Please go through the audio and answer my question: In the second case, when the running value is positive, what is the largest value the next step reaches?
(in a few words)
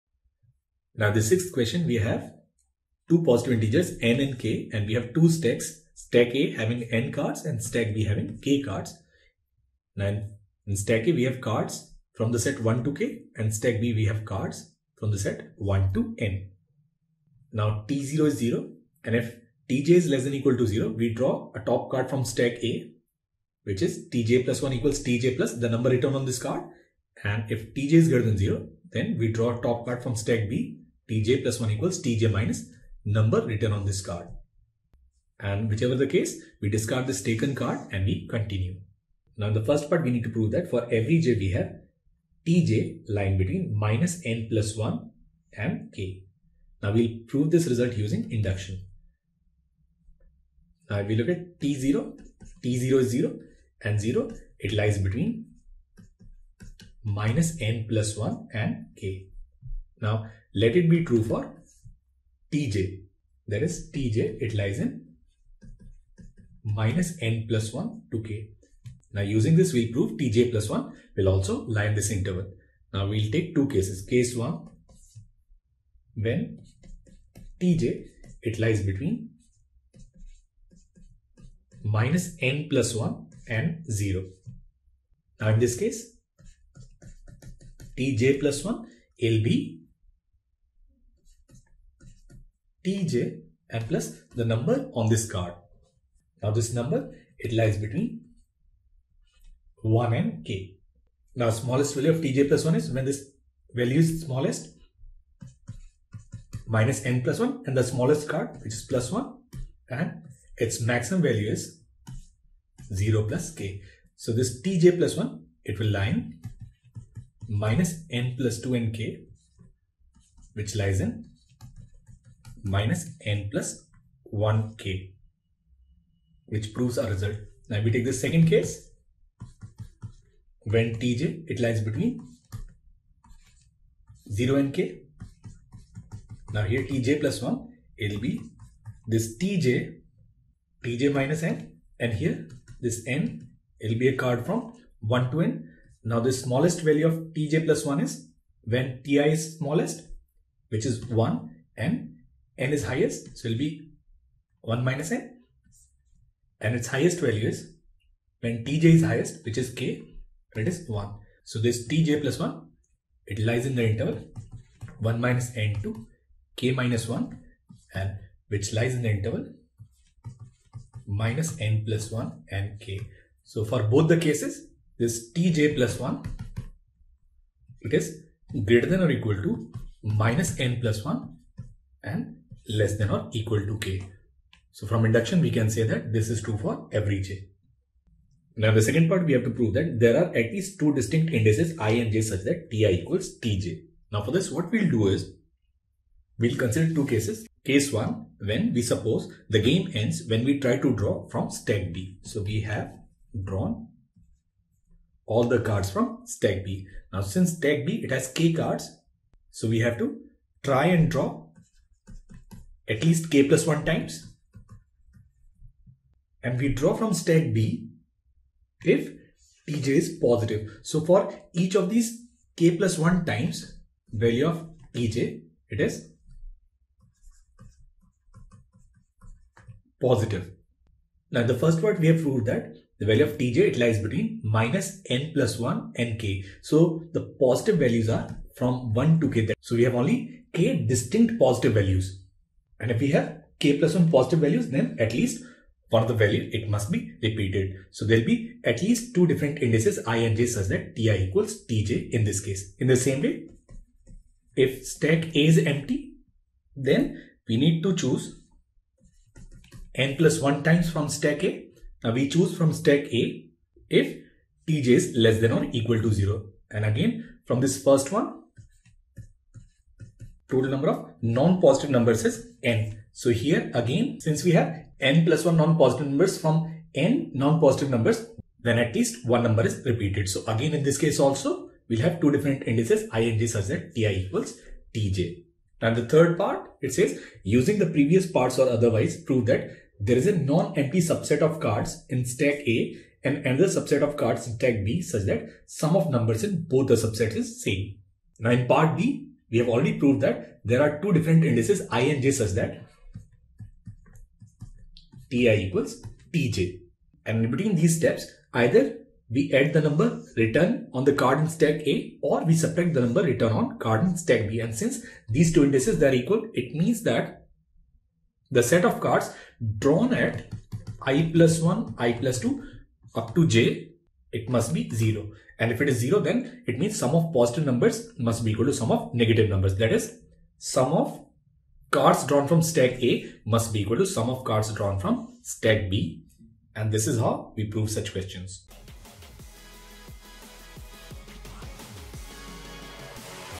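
k - 1.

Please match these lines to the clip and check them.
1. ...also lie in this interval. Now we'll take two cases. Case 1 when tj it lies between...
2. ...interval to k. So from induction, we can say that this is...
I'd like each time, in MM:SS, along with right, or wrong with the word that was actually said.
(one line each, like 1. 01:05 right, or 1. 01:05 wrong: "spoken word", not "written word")
1. 01:11 right
2. 03:03 wrong: "equal", not "interval".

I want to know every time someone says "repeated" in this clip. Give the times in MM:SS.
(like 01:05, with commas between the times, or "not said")
04:07, 04:39.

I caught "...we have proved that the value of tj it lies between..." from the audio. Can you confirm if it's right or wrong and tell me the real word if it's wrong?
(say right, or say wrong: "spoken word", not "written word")
right.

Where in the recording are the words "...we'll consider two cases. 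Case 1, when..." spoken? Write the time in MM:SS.
03:16.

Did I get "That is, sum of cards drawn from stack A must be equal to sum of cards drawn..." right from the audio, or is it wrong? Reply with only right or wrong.
right.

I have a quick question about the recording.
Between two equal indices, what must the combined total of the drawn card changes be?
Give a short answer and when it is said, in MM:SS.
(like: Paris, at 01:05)
0, at 05:24.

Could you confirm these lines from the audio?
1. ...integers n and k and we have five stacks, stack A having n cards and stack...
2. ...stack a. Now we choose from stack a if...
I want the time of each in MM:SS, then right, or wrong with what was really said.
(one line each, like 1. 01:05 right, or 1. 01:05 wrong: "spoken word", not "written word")
1. 00:03 wrong: "two", not "five"
2. 04:21 right.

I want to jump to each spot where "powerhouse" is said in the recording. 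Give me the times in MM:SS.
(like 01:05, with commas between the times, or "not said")
not said.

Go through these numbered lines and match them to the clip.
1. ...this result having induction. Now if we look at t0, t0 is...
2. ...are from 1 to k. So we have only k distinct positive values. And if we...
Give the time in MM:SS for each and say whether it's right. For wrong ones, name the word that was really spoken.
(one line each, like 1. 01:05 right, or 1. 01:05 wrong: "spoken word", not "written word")
1. 00:47 wrong: "using", not "having"
2. 03:58 right.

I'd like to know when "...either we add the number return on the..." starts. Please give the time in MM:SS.
05:08.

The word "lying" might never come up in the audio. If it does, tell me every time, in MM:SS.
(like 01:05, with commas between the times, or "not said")
00:43.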